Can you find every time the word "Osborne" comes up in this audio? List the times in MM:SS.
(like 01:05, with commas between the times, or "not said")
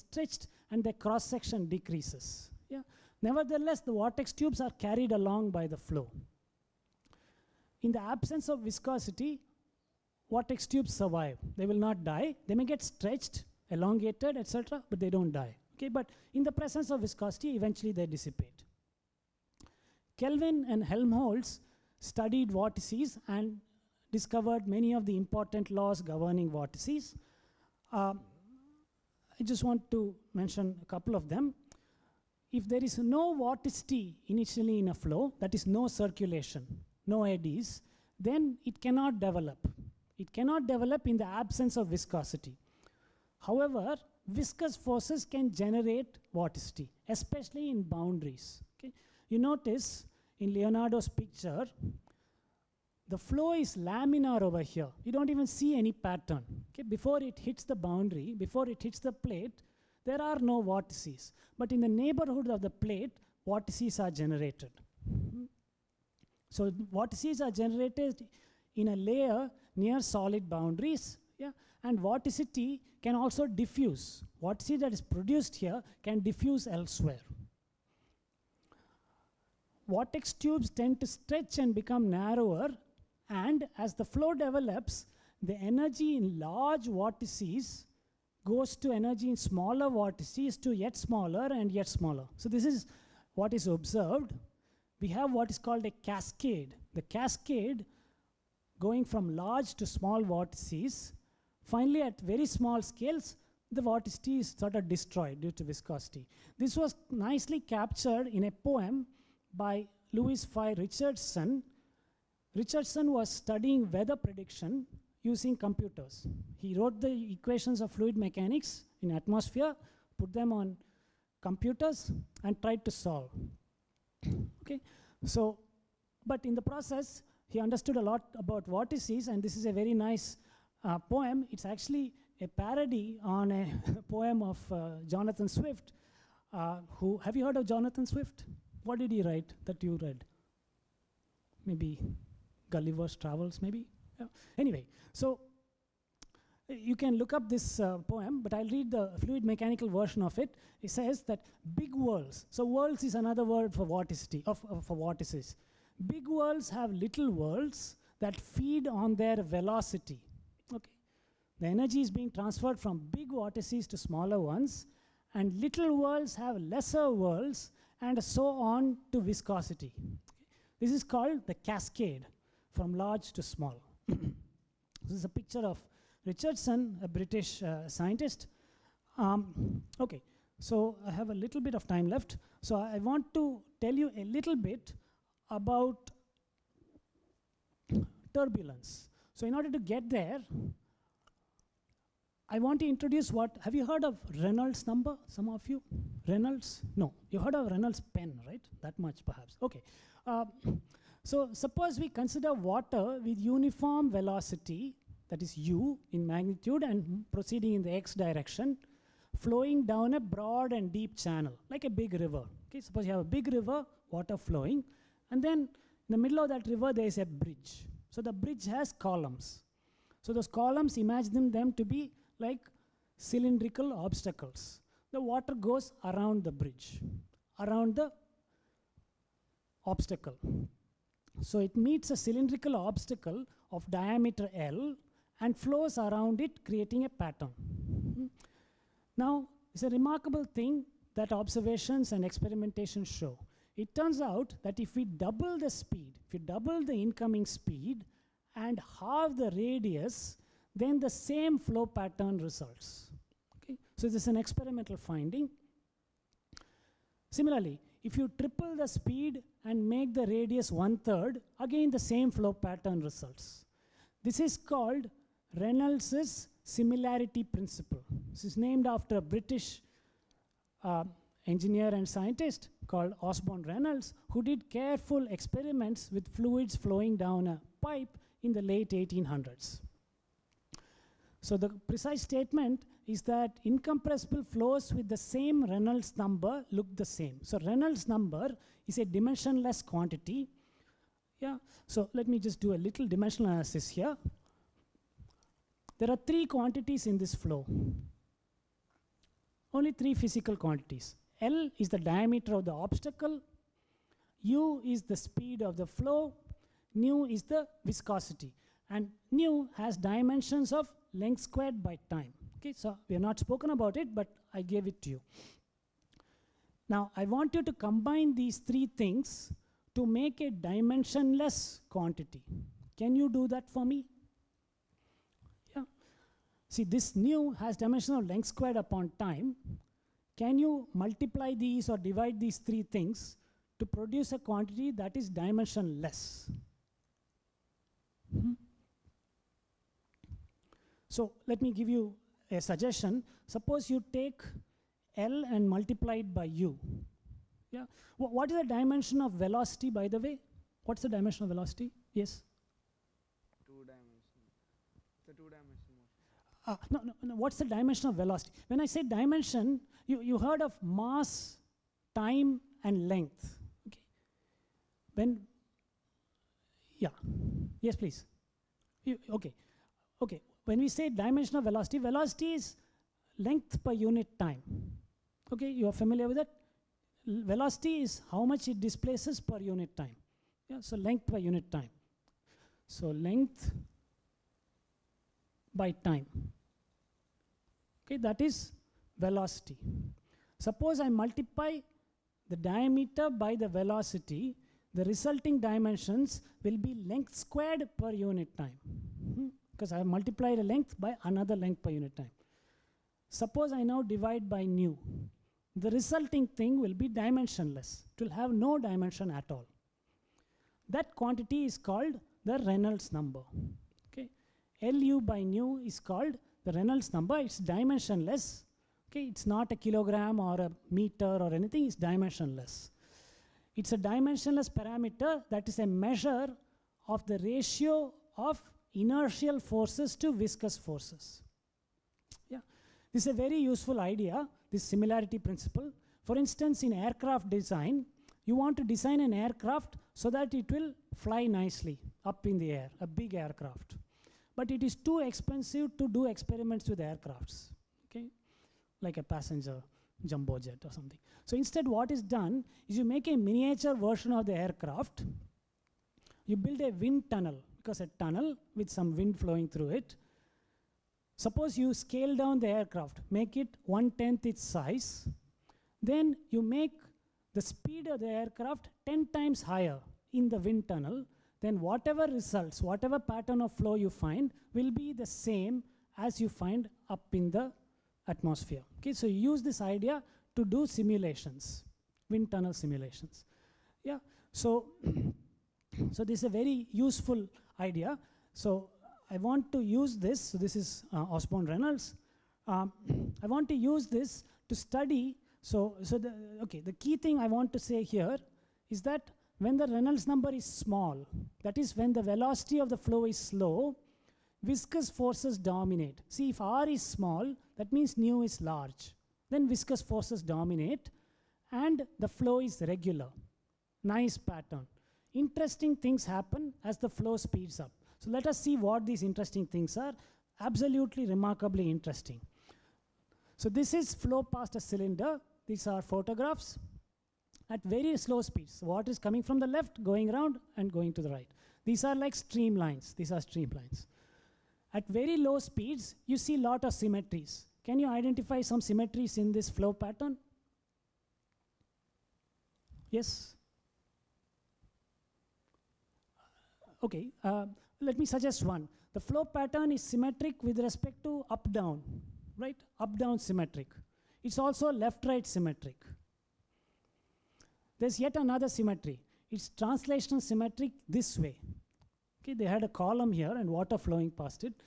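04:33, 08:11.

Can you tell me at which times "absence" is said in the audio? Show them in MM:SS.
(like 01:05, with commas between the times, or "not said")
00:07, 00:41.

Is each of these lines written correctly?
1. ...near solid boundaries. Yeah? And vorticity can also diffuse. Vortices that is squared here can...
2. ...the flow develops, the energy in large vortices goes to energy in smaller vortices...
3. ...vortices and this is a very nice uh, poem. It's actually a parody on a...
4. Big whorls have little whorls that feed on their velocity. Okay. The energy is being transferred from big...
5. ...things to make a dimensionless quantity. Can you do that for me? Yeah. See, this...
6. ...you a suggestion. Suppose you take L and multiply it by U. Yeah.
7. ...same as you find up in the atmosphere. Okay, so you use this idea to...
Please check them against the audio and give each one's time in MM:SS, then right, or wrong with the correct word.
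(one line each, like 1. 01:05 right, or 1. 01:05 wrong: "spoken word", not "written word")
1. 01:09 wrong: "produced", not "squared"
2. 01:23 right
3. 02:08 right
4. 02:36 right
5. 05:18 right
6. 05:41 right
7. 07:55 right.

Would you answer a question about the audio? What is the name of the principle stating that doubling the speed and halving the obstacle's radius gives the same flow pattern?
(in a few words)
Reynolds' similarity principle.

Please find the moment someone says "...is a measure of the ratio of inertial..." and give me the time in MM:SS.
07:05.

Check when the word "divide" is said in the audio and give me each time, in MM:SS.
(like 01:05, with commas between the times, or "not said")
05:31, 06:44.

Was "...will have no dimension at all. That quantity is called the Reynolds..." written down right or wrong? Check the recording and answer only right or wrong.
right.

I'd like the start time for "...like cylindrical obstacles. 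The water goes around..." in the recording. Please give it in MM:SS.
03:42.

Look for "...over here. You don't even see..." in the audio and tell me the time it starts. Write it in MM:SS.
00:54.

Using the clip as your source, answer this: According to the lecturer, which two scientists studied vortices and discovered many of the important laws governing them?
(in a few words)
Kelvin and Helmholtz.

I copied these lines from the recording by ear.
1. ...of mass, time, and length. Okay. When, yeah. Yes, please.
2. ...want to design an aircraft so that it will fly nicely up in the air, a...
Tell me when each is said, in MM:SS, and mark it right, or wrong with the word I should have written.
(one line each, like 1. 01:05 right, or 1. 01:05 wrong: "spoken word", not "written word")
1. 06:00 right
2. 07:18 right.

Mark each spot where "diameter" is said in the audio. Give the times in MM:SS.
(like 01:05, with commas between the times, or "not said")
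03:53, 05:01, 06:32.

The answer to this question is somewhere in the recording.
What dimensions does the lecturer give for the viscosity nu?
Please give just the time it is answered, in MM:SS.
05:11.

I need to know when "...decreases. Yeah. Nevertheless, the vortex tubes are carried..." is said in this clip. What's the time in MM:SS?
00:01.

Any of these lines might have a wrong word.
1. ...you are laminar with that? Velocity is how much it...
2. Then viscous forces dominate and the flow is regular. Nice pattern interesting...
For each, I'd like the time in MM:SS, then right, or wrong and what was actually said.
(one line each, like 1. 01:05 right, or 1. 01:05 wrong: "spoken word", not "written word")
1. 06:15 wrong: "familiar", not "laminar"
2. 08:29 right.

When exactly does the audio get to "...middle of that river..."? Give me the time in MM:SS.
03:36.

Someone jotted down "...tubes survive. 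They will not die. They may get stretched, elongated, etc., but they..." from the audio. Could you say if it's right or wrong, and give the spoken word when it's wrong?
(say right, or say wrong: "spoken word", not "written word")
right.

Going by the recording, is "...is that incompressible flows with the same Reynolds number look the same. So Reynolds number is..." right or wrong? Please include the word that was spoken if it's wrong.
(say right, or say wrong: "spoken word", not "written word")
right.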